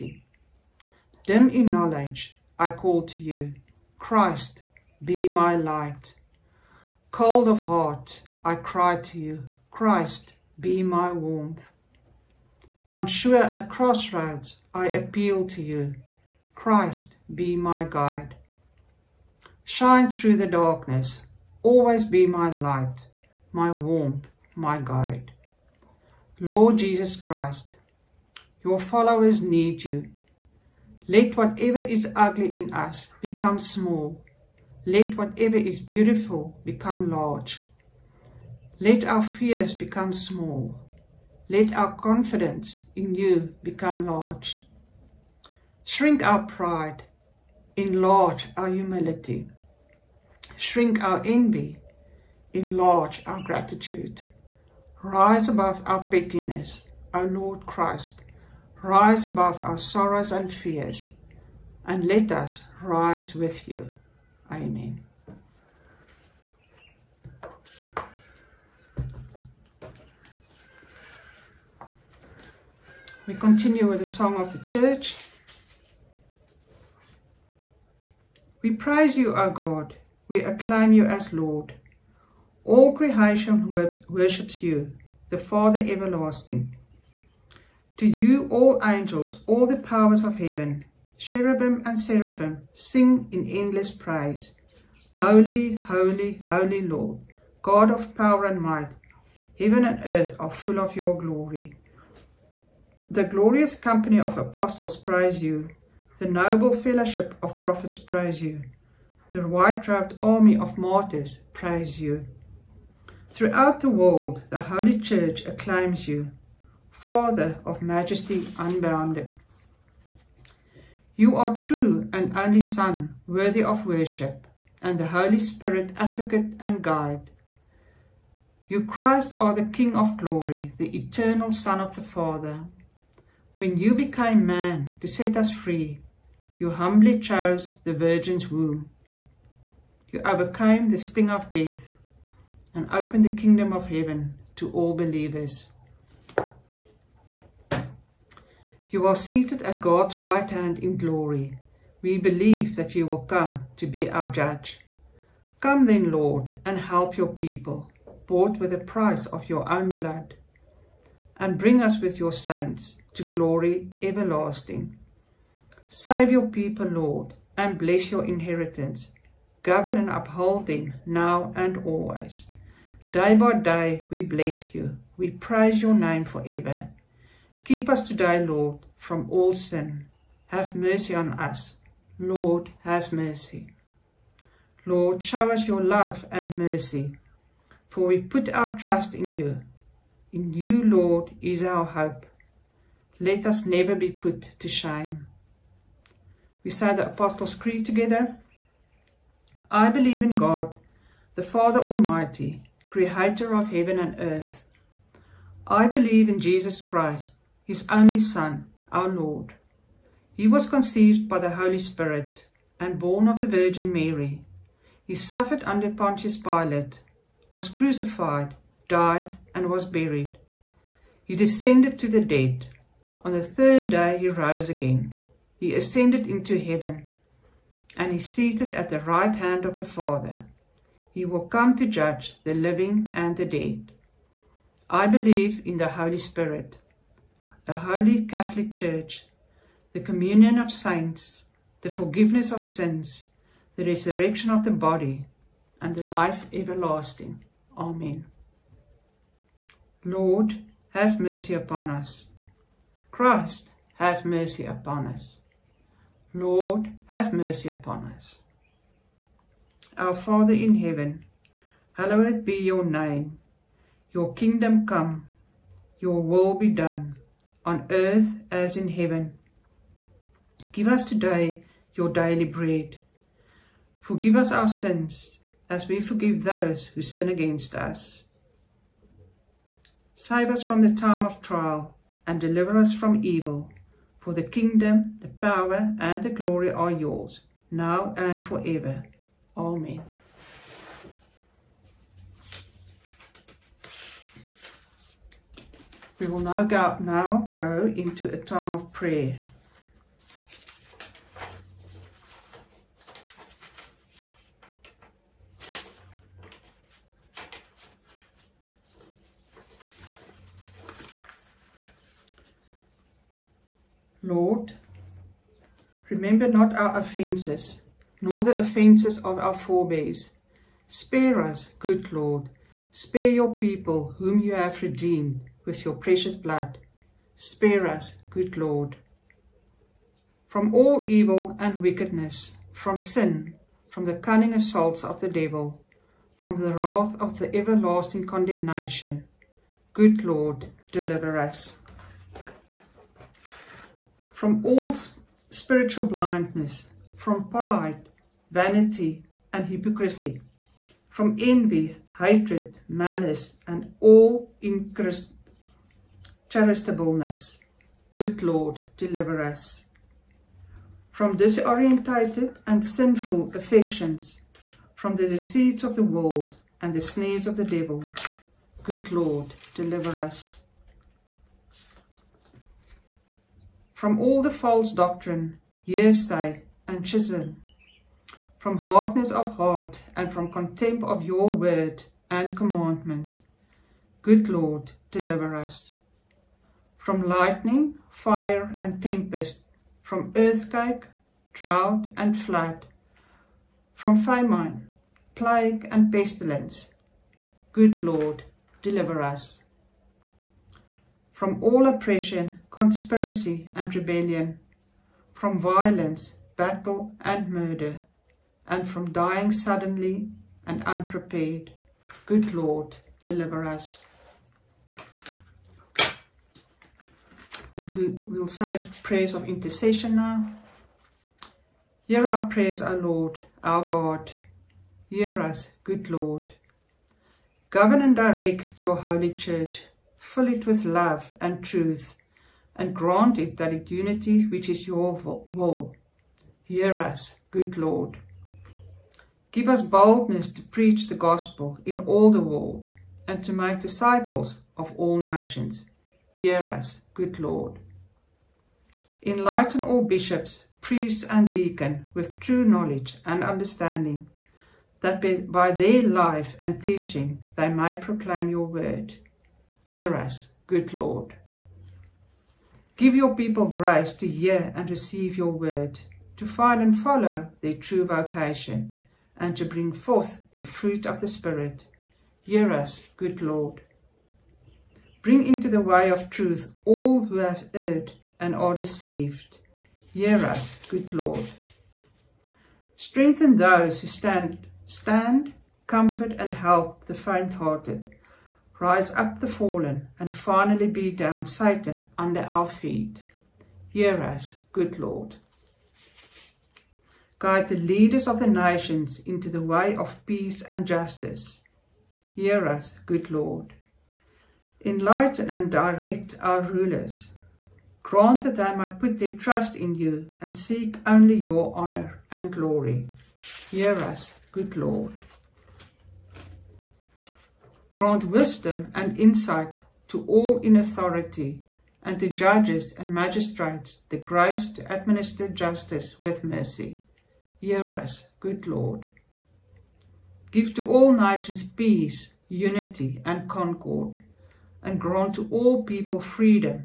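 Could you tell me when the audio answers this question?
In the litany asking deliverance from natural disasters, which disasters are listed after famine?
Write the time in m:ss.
6:35.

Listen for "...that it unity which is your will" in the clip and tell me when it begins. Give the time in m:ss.
7:13.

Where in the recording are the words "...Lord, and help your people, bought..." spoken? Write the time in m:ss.
2:36.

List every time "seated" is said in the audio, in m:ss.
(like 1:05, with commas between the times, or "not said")
2:29, 3:48.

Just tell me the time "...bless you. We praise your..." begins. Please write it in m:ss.
2:54.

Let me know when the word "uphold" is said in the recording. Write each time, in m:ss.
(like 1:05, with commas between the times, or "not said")
2:50.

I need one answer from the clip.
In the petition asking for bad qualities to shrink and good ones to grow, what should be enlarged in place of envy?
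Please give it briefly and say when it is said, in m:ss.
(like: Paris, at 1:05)
gratitude, at 0:52.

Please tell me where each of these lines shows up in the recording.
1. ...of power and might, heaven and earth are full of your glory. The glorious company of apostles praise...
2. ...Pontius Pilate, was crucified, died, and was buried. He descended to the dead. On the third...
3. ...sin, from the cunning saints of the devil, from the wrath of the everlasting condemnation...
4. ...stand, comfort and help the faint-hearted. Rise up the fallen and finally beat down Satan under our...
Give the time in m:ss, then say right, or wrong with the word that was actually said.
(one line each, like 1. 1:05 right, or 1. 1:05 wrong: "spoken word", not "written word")
1. 1:37 right
2. 3:35 right
3. 5:32 wrong: "assaults", not "saints"
4. 8:04 right.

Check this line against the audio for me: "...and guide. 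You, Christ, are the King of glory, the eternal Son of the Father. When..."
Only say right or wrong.
right.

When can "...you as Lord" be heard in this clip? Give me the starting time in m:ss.
1:20.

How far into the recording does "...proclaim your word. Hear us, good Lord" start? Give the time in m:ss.
7:37.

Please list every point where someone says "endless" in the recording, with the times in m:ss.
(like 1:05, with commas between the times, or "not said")
1:33.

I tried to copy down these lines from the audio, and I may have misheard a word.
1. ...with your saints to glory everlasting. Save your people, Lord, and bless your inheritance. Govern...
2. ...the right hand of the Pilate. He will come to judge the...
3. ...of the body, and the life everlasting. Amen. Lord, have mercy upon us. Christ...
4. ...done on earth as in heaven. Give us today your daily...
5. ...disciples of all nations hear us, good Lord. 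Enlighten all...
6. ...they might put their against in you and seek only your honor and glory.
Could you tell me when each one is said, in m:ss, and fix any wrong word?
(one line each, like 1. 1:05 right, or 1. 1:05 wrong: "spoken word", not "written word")
1. 2:41 right
2. 3:48 wrong: "Father", not "Pilate"
3. 4:04 right
4. 4:26 right
5. 7:23 right
6. 8:28 wrong: "trust", not "against".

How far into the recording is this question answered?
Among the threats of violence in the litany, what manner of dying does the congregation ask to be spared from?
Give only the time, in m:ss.
6:49.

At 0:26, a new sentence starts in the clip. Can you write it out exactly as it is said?
Lord Jesus Christ, your followers need you.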